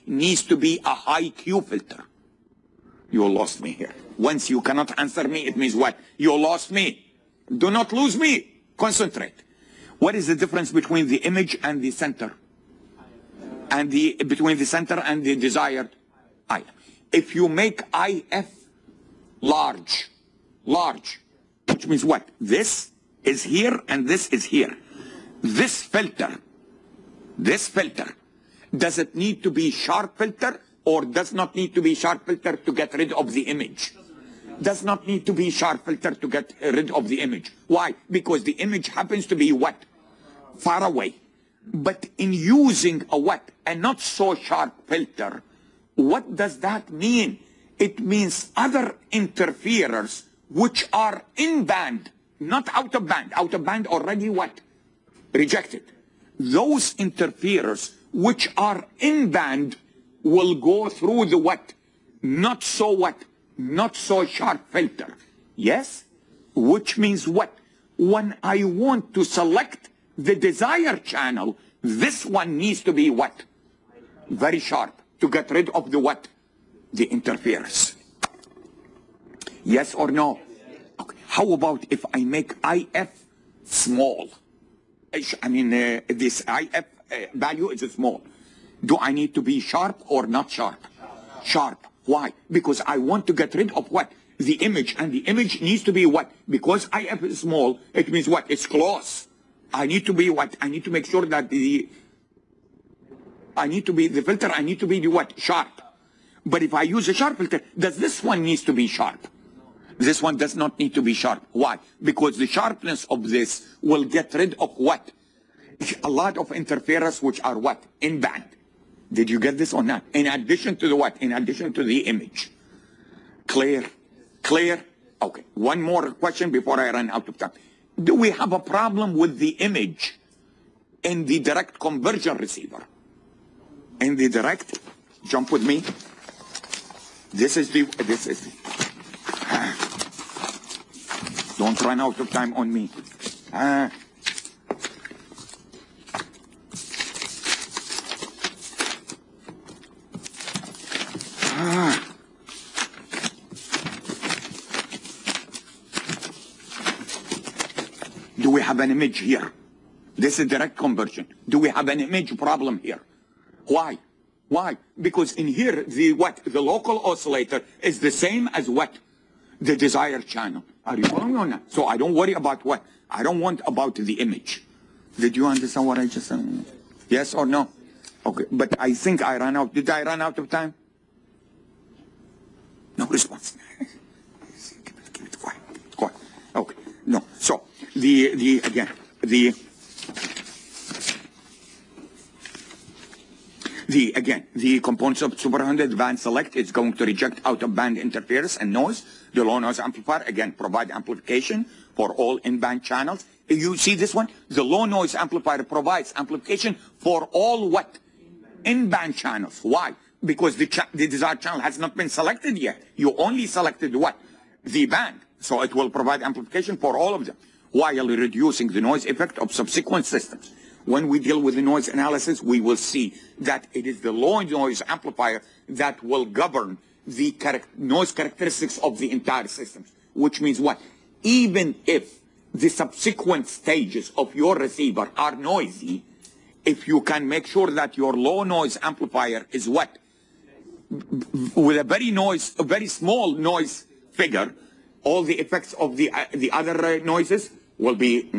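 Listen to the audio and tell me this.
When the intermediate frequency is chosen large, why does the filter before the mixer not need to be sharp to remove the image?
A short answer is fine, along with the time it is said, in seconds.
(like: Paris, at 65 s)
Far away, at 40 s.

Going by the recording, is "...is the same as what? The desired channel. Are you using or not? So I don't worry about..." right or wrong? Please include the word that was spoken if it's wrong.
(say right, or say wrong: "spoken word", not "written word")
wrong: "following", not "using".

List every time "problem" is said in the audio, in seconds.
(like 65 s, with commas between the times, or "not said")
128 s, 162 s.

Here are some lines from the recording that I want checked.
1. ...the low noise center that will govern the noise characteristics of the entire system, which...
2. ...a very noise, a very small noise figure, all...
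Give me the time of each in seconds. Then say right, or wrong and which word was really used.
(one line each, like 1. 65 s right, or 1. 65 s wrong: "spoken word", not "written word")
1. 224 s wrong: "amplifier", not "center"
2. 241 s right.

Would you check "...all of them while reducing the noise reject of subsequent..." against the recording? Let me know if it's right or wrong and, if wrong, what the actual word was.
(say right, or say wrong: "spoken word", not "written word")
wrong: "effect", not "reject".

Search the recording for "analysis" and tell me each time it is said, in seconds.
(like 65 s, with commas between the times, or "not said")
221 s.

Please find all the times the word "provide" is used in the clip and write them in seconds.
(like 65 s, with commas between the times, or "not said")
200 s, 205 s, 215 s.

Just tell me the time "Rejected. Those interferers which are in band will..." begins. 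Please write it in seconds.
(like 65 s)
55 s.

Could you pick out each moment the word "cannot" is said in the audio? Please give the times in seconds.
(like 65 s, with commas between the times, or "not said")
4 s.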